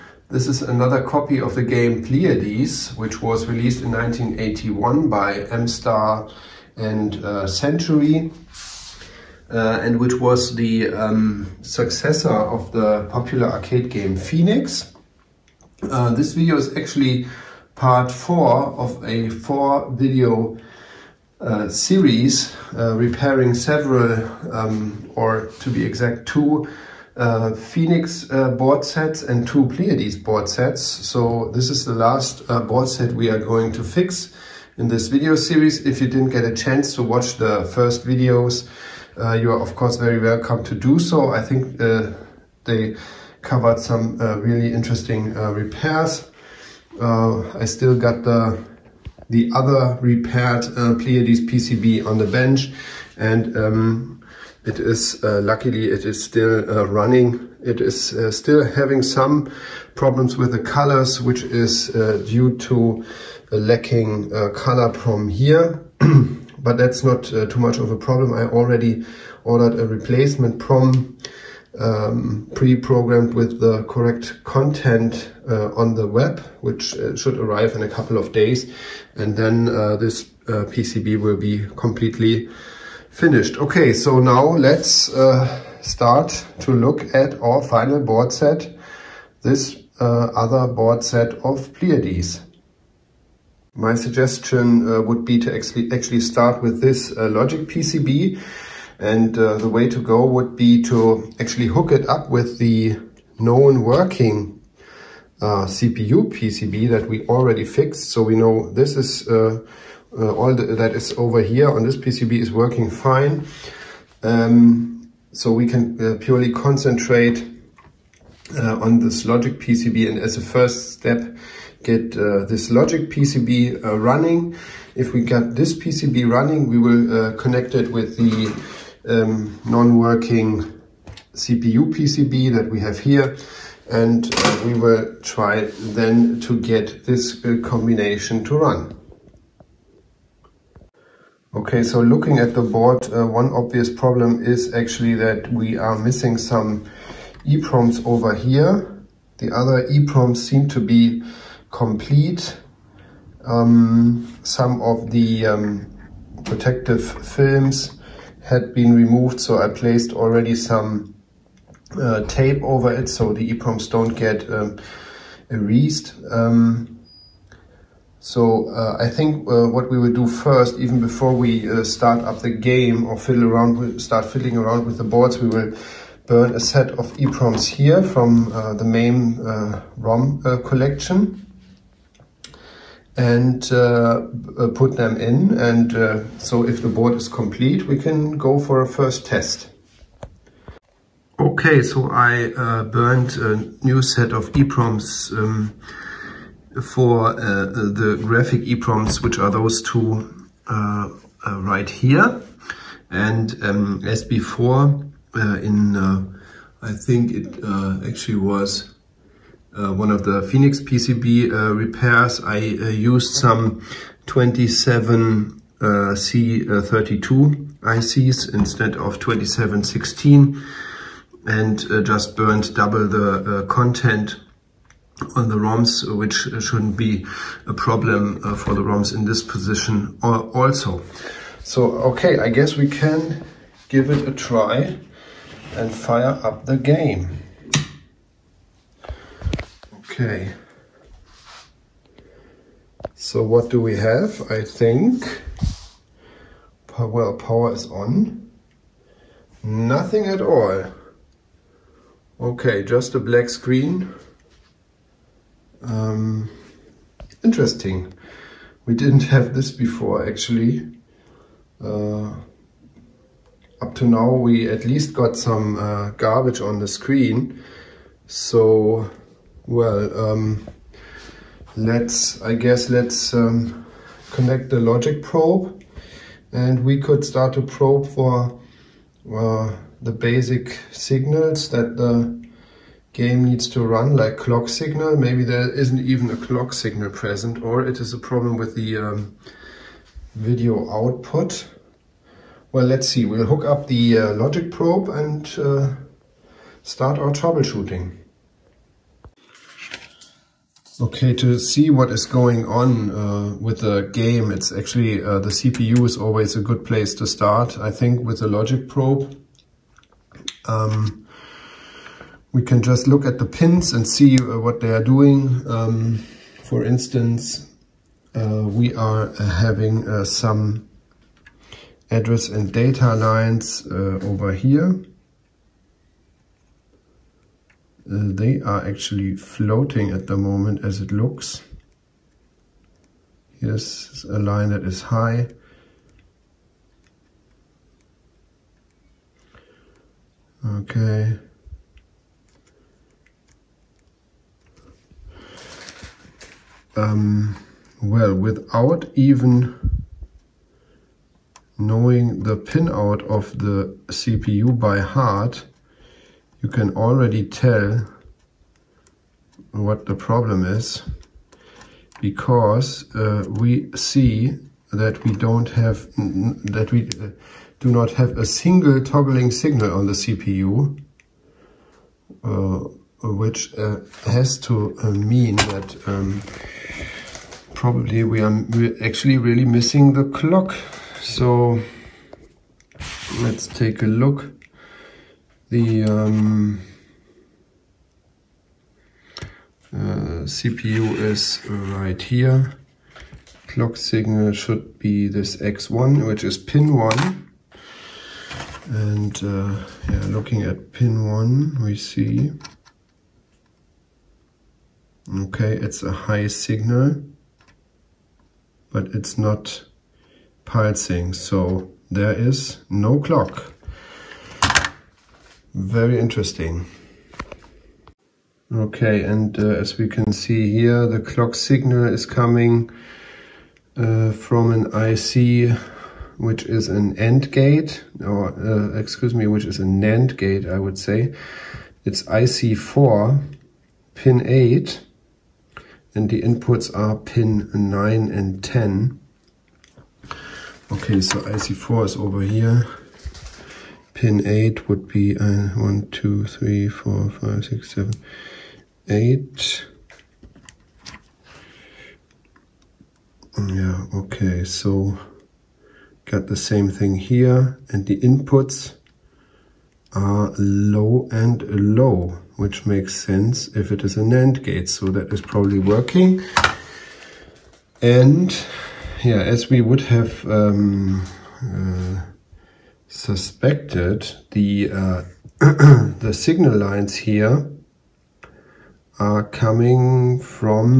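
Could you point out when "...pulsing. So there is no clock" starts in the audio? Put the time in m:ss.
6:50.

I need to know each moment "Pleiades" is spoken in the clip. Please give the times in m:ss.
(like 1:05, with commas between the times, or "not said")
0:02, 0:29, 0:50, 1:31.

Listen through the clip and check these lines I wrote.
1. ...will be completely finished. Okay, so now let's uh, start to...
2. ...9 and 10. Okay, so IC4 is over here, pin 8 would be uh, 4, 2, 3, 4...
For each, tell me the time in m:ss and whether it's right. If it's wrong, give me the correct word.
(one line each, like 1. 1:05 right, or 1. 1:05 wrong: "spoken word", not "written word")
1. 1:21 right
2. 7:17 wrong: "1", not "4".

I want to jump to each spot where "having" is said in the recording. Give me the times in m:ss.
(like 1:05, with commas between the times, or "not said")
0:58, 5:19.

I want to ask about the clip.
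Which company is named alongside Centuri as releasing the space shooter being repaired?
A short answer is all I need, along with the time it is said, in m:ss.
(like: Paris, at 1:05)
MStar, at 0:05.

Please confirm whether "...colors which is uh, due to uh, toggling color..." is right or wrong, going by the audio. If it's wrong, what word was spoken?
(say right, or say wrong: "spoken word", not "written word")
wrong: "lacking", not "toggling".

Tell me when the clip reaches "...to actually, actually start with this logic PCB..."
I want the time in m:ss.
1:35.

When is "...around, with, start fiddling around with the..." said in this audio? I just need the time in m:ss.
2:53.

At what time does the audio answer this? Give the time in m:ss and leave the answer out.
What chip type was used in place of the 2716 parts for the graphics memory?
3:34.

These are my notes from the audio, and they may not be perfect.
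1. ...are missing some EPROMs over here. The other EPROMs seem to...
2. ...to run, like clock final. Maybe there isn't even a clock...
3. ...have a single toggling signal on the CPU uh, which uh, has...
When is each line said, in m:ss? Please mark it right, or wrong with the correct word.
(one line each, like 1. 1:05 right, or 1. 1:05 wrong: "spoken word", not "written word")
1. 2:25 right
2. 4:43 wrong: "signal", not "final"
3. 6:08 right.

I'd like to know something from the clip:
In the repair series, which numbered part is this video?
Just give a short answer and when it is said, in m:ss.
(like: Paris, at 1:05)
4, at 0:17.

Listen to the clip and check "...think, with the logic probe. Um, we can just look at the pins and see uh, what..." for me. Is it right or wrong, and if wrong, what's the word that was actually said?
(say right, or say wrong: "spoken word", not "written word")
right.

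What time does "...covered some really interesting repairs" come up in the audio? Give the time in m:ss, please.
0:43.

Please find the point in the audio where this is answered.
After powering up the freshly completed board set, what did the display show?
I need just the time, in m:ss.
4:12.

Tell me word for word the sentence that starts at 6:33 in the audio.
Clock signal should be this X1, which is pin 1.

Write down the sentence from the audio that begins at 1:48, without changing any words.
So we know this is uh, uh all the, that is over here on this PCB is working fine.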